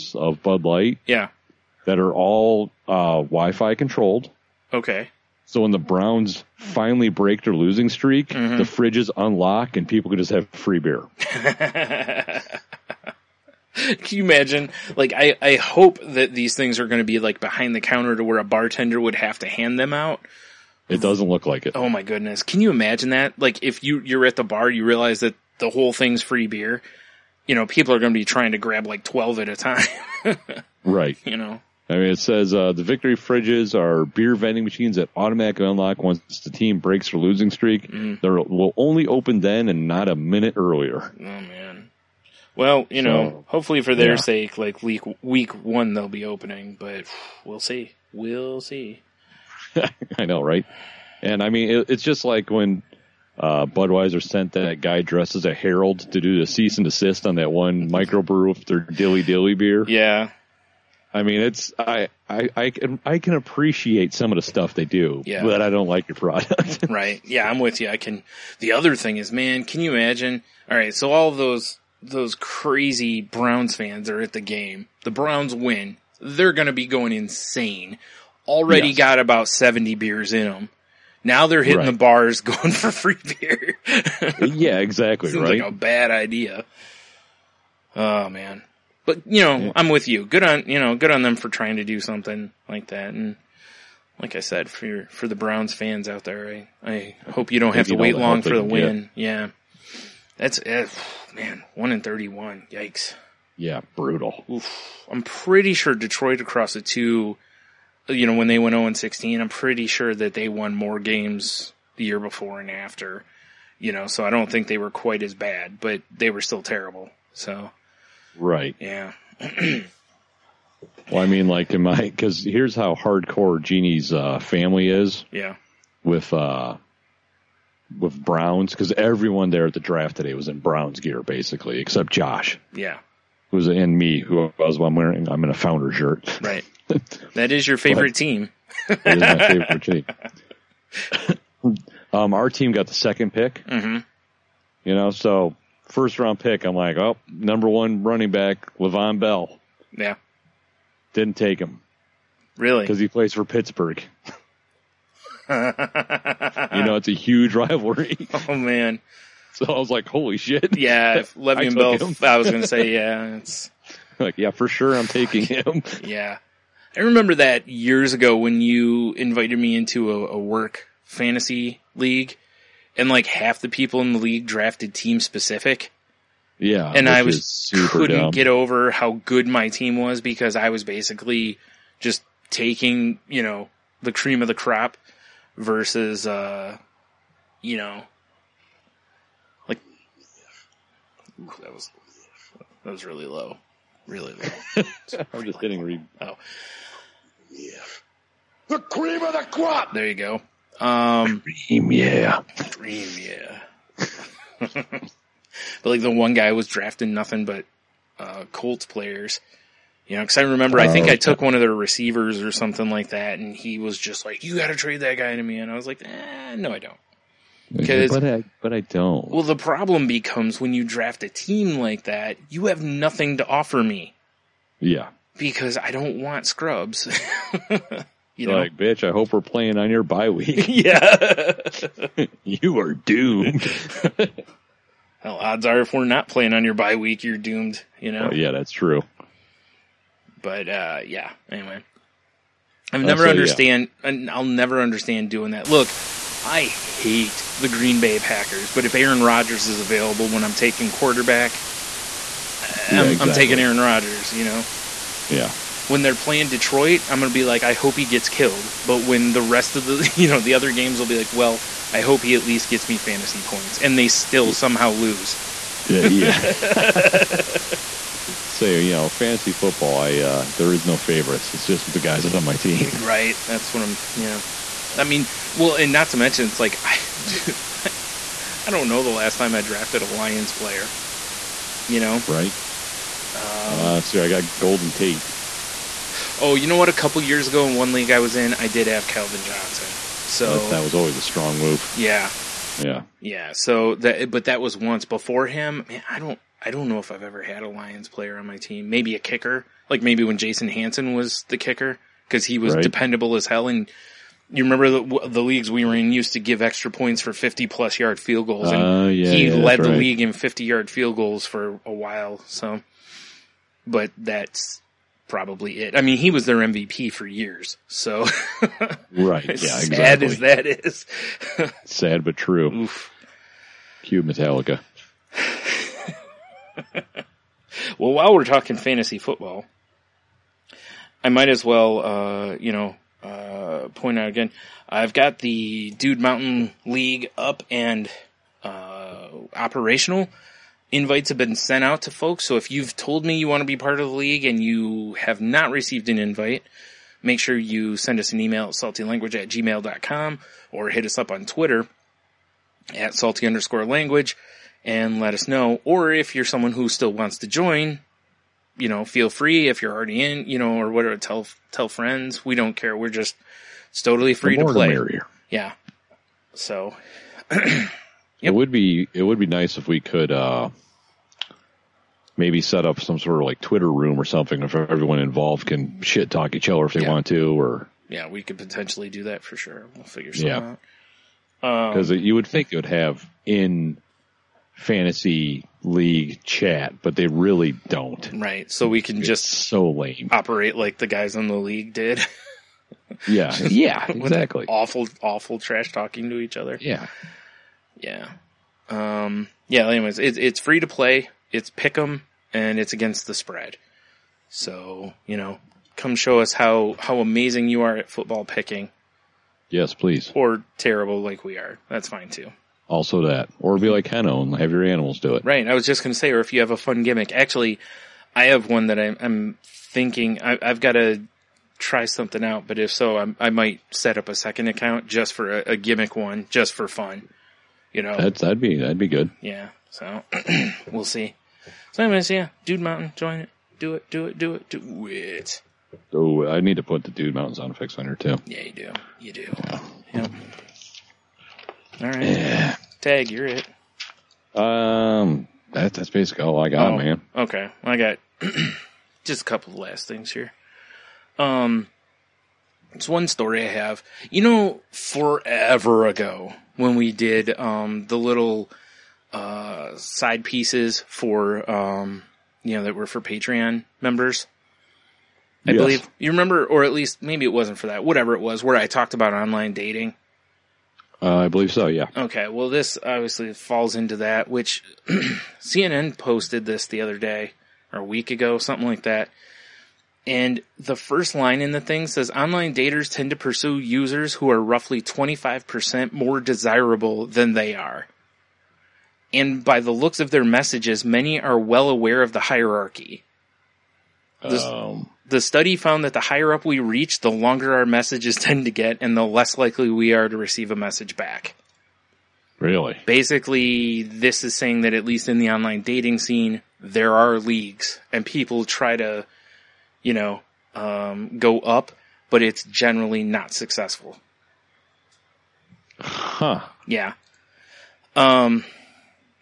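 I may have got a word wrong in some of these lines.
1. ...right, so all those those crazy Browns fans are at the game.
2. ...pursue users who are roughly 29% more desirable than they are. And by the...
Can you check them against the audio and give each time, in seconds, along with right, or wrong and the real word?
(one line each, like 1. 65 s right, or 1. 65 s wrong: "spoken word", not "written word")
1. 70 s right
2. 483 s wrong: "25", not "29".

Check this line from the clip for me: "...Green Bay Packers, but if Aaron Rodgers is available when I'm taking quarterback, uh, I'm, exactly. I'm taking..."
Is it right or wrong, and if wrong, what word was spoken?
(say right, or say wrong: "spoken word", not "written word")
right.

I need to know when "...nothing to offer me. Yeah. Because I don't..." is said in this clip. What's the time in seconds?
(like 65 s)
222 s.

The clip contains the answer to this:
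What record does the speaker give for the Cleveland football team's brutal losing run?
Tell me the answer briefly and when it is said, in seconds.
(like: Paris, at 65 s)
1 in 31, at 101 s.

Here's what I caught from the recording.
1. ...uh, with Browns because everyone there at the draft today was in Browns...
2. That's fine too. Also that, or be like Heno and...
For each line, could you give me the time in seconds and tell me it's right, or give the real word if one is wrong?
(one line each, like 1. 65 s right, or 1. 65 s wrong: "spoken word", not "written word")
1. 126 s right
2. 411 s right.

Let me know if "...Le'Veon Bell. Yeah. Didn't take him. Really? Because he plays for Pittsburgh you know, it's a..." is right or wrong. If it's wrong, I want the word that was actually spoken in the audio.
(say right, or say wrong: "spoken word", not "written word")
right.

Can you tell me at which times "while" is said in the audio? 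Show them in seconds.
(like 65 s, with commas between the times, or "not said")
311 s, 328 s.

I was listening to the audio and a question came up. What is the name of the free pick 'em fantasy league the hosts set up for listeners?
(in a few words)
Dude Mountain League.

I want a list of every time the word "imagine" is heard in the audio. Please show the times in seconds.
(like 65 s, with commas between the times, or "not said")
14 s, 22 s, 69 s.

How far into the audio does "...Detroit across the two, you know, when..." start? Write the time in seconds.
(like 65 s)
105 s.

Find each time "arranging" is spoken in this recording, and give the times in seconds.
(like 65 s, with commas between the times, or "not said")
not said.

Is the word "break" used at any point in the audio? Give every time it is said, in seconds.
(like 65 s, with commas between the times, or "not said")
7 s, 36 s.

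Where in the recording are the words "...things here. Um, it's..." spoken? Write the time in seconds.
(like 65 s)
450 s.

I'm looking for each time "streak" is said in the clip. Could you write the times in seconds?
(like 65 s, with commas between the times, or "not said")
7 s, 37 s.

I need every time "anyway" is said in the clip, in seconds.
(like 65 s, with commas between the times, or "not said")
241 s, 399 s, 432 s.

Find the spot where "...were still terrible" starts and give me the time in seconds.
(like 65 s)
116 s.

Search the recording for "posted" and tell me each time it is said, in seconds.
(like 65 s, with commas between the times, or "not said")
476 s.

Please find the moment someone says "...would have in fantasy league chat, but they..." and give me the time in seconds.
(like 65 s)
382 s.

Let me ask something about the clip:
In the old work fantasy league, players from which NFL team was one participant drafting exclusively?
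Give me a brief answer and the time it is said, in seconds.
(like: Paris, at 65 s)
Colts, at 208 s.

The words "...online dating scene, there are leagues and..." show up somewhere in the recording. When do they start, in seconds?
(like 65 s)
505 s.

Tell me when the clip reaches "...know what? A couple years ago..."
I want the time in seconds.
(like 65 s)
286 s.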